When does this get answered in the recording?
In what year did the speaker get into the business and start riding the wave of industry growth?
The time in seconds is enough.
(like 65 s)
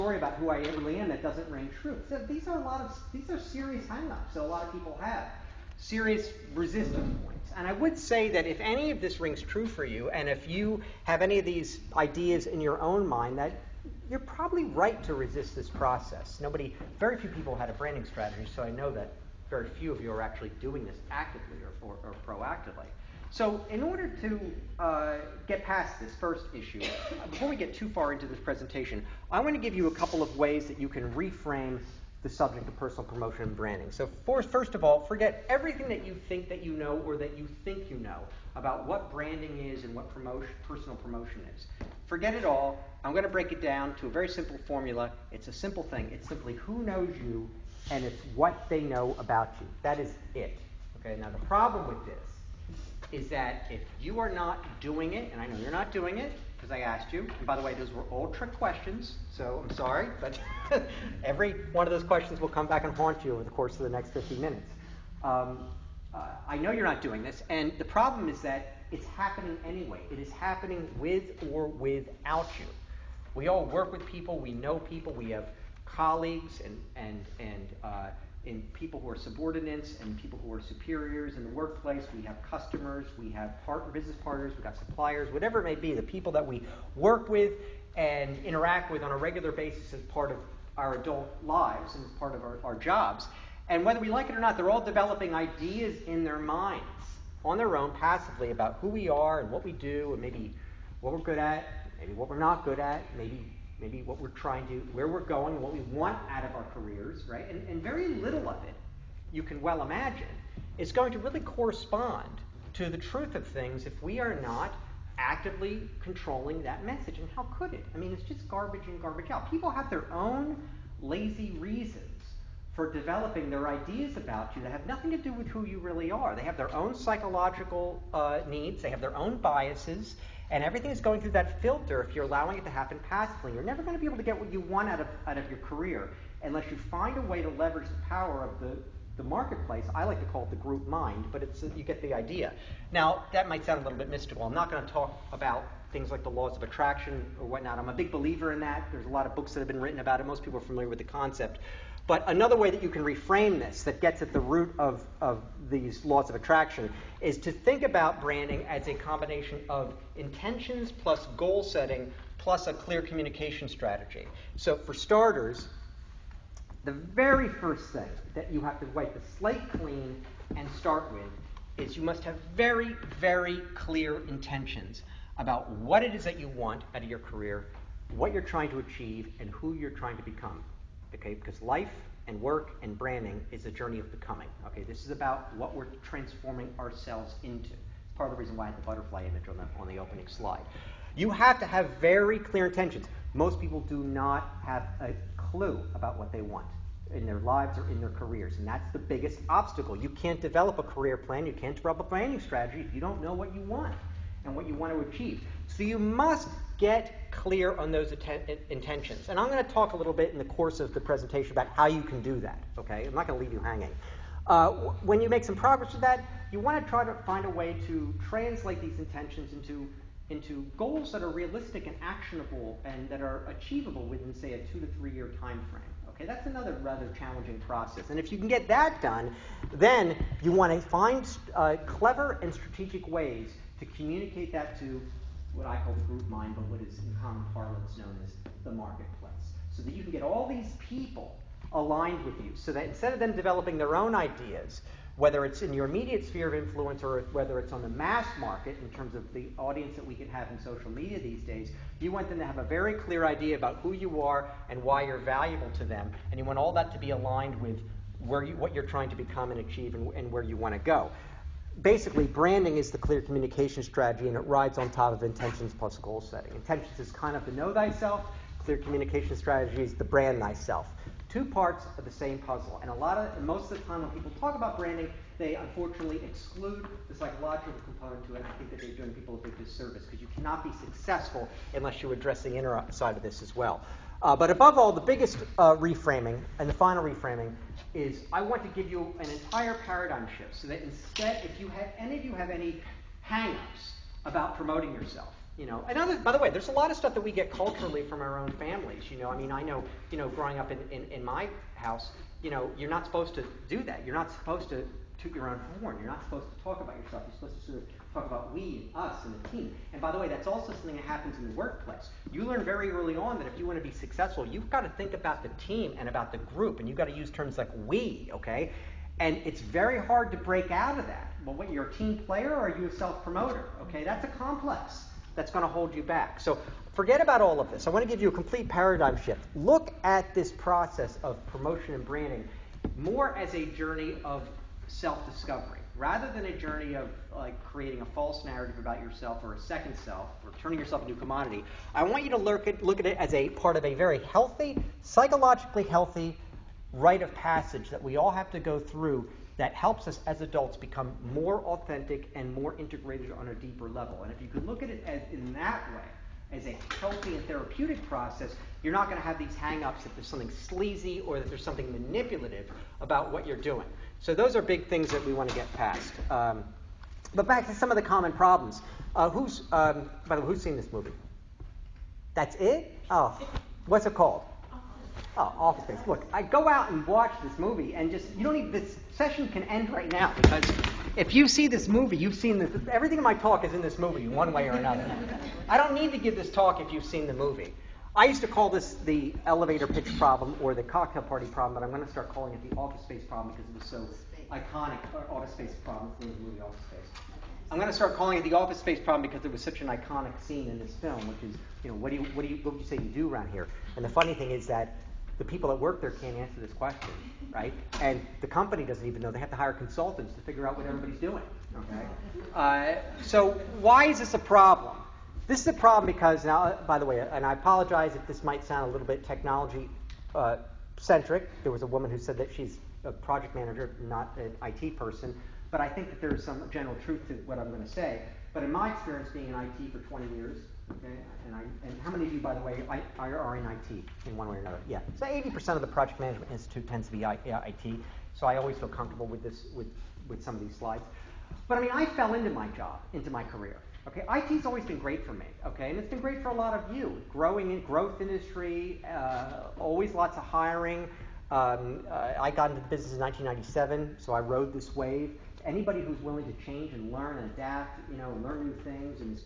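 453 s.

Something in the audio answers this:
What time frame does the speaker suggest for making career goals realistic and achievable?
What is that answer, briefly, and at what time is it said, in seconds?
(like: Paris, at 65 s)
2 to 3 years, at 224 s.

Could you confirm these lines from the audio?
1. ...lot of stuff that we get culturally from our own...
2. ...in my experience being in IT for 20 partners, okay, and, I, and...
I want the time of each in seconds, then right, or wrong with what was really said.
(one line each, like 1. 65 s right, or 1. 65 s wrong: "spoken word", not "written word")
1. 296 s right
2. 428 s wrong: "years", not "partners".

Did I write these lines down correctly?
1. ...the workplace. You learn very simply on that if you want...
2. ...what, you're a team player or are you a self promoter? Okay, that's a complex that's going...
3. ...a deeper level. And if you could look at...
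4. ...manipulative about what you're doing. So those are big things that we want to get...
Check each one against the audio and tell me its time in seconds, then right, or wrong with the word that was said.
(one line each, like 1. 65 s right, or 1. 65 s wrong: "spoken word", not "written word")
1. 311 s wrong: "early", not "simply"
2. 321 s right
3. 353 s right
4. 361 s right.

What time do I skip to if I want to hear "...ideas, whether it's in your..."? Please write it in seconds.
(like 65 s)
244 s.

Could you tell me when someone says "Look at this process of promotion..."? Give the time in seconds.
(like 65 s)
329 s.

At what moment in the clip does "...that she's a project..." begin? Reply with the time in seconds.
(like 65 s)
422 s.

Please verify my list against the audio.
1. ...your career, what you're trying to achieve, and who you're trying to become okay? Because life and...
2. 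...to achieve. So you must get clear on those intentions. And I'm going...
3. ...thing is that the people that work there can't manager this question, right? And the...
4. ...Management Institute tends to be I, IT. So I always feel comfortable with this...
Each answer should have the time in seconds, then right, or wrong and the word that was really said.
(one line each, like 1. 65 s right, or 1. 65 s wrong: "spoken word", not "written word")
1. 177 s right
2. 204 s right
3. 404 s wrong: "answer", not "manager"
4. 436 s right.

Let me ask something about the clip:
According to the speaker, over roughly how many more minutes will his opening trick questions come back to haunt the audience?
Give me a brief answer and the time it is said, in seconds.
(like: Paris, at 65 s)
50, at 64 s.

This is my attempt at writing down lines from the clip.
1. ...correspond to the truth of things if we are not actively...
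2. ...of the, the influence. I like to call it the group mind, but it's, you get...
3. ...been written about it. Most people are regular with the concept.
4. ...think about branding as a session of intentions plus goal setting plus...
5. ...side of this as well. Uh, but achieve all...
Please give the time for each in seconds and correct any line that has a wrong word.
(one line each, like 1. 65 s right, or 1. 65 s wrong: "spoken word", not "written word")
1. 111 s right
2. 138 s wrong: "marketplace", not "influence"
3. 149 s wrong: "familiar", not "regular"
4. 157 s wrong: "combination", not "session"
5. 282 s wrong: "above", not "achieve".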